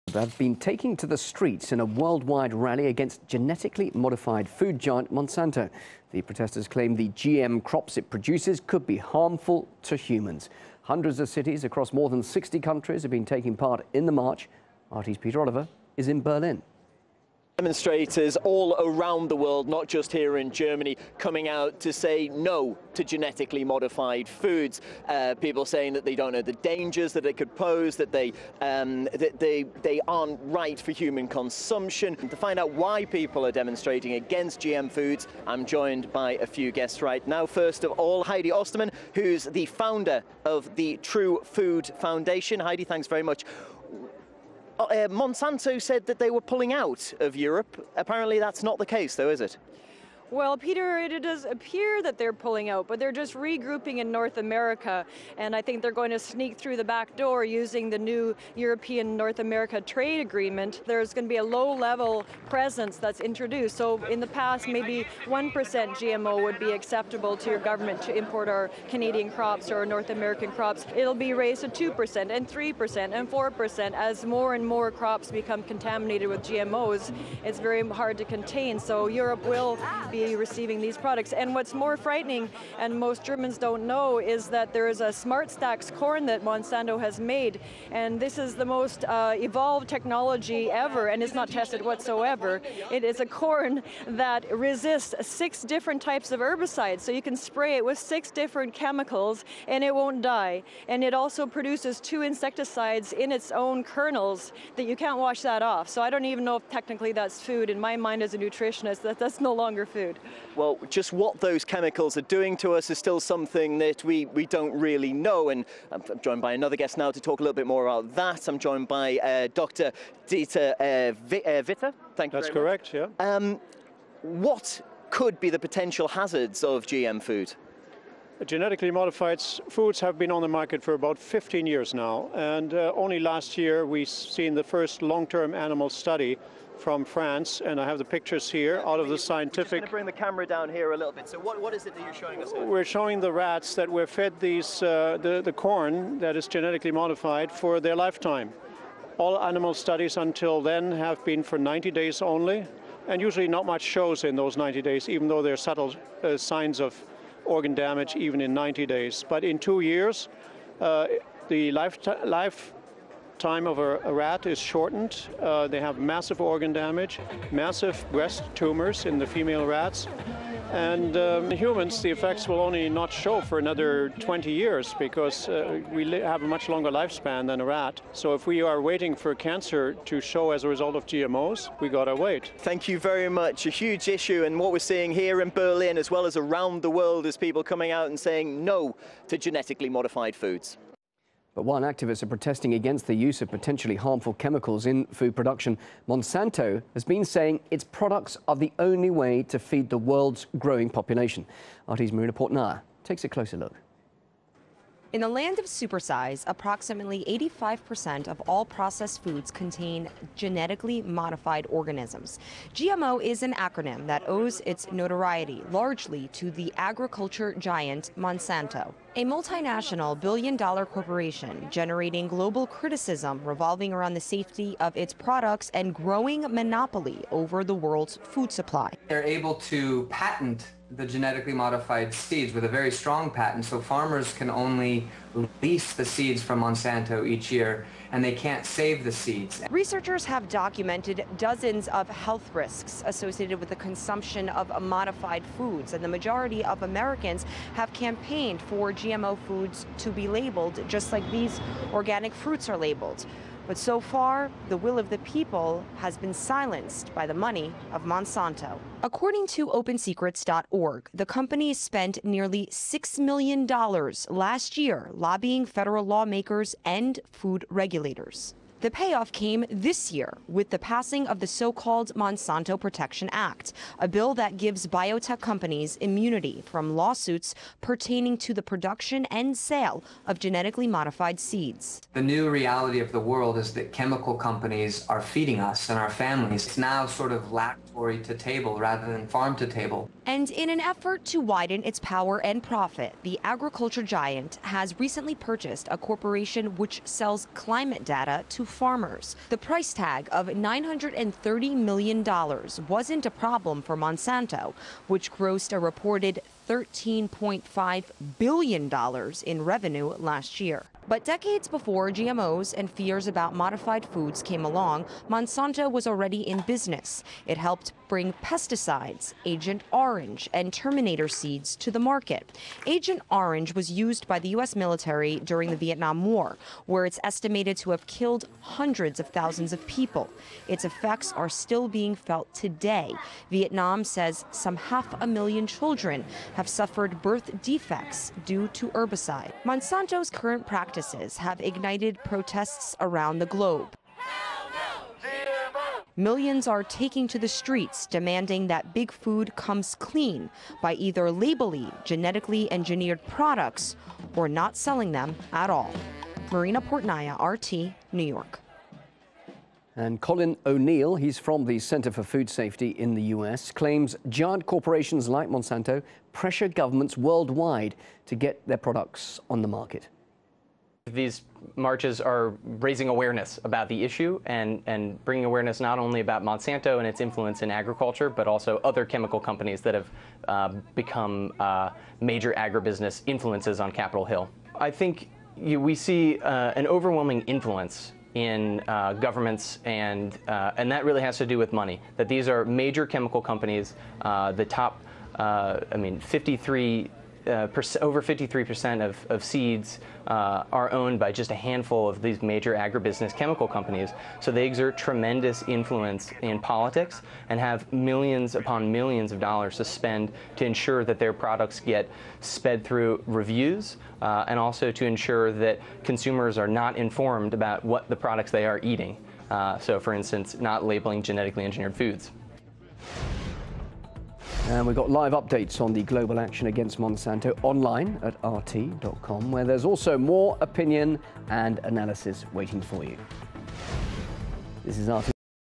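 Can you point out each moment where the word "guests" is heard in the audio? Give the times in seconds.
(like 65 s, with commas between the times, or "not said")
36 s, 116 s.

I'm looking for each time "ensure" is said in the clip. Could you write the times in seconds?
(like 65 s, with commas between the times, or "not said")
410 s, 415 s.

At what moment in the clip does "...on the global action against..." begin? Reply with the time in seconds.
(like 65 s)
425 s.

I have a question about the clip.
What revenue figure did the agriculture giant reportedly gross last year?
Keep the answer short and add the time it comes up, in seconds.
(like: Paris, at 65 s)
$13.5 billion, at 306 s.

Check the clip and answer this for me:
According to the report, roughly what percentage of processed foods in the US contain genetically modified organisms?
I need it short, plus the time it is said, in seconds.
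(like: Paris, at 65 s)
85%, at 207 s.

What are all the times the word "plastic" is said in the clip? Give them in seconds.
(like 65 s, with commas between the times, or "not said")
not said.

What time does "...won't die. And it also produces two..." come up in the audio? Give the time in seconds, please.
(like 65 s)
99 s.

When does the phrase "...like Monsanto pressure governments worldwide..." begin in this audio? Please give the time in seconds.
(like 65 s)
365 s.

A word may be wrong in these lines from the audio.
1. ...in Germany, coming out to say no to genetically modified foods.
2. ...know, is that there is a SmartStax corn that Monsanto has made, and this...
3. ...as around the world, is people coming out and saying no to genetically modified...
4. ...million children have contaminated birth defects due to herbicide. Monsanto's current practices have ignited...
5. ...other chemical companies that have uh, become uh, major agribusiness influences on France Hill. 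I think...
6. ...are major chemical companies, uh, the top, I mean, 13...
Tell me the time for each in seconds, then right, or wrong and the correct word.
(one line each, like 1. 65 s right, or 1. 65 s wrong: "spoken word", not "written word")
1. 20 s right
2. 83 s right
3. 186 s right
4. 335 s wrong: "suffered", not "contaminated"
5. 378 s wrong: "Capitol", not "France"
6. 392 s wrong: "53", not "13".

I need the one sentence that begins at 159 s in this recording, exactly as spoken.
But in two years, uh, the lifetime life time of a, a, rat is shortened.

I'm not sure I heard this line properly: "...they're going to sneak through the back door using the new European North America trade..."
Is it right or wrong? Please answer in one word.
right.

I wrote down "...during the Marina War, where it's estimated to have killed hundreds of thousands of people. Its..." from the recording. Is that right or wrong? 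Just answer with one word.
wrong.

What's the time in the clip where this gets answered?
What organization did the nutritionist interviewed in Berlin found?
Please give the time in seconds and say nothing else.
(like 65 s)
41 s.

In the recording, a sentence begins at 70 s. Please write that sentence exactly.
It'll be raised to 2% and 3% and 4% as more and more crops become contaminated with GMOs.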